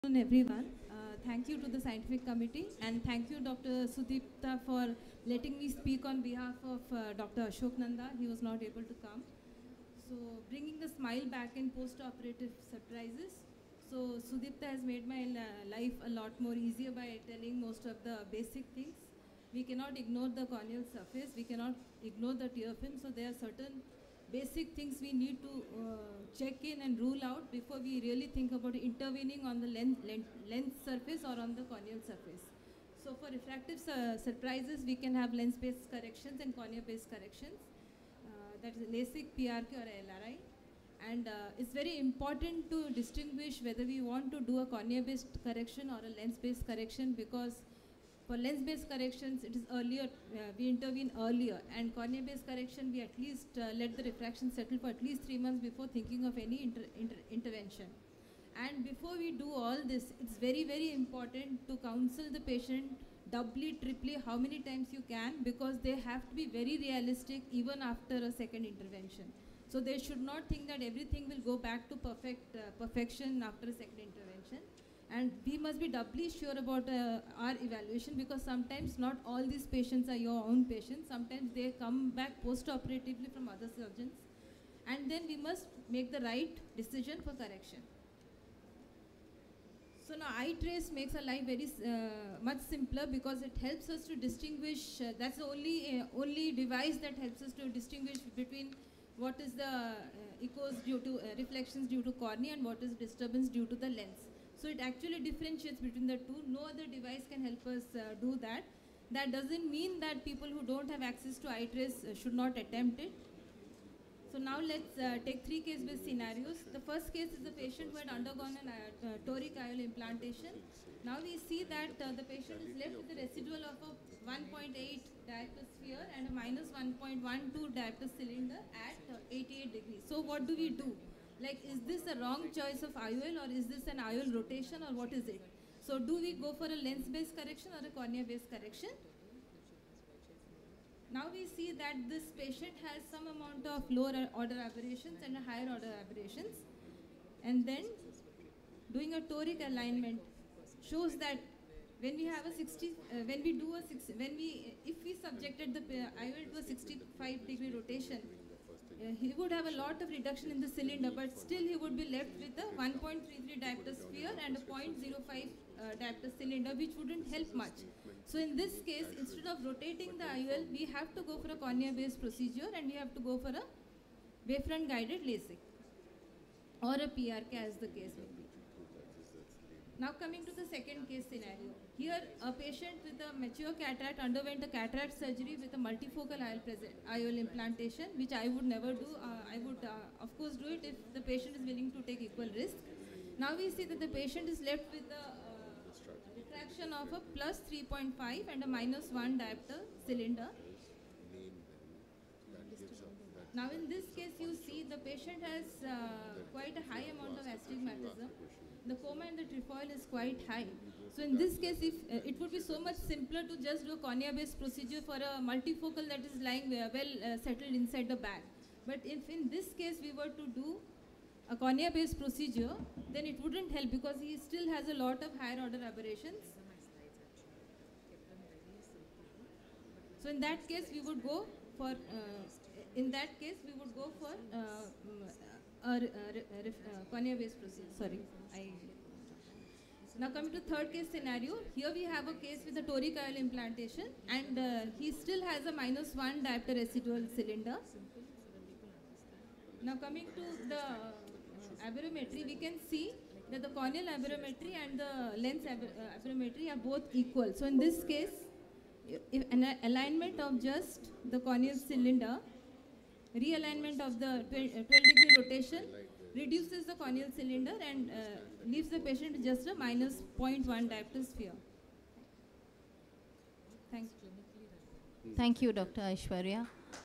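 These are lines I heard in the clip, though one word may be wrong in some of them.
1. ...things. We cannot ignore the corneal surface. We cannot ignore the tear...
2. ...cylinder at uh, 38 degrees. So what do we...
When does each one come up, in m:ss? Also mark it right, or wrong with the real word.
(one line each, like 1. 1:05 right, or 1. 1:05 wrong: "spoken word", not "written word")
1. 0:18 right
2. 2:08 wrong: "88", not "38".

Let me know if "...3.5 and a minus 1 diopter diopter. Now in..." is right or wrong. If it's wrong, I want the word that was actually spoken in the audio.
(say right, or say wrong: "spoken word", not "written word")
wrong: "cylinder", not "diopter".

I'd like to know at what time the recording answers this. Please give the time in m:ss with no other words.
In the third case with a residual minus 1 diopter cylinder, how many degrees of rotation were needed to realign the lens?
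4:24.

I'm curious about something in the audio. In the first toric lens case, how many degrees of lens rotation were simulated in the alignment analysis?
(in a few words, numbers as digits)
65 degrees.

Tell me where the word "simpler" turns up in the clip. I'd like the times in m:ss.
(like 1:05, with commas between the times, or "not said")
1:32, 3:33.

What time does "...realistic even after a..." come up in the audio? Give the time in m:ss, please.
1:06.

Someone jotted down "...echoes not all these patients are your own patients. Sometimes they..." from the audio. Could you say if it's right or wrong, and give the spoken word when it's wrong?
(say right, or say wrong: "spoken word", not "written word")
wrong: "sometimes", not "echoes".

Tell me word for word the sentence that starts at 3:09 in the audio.
Uh, I would uh, of course do it if the patient is willing to take equal risk.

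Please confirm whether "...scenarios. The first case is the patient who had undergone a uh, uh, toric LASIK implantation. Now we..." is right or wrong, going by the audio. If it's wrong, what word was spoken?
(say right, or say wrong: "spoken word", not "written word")
wrong: "IOL", not "LASIK".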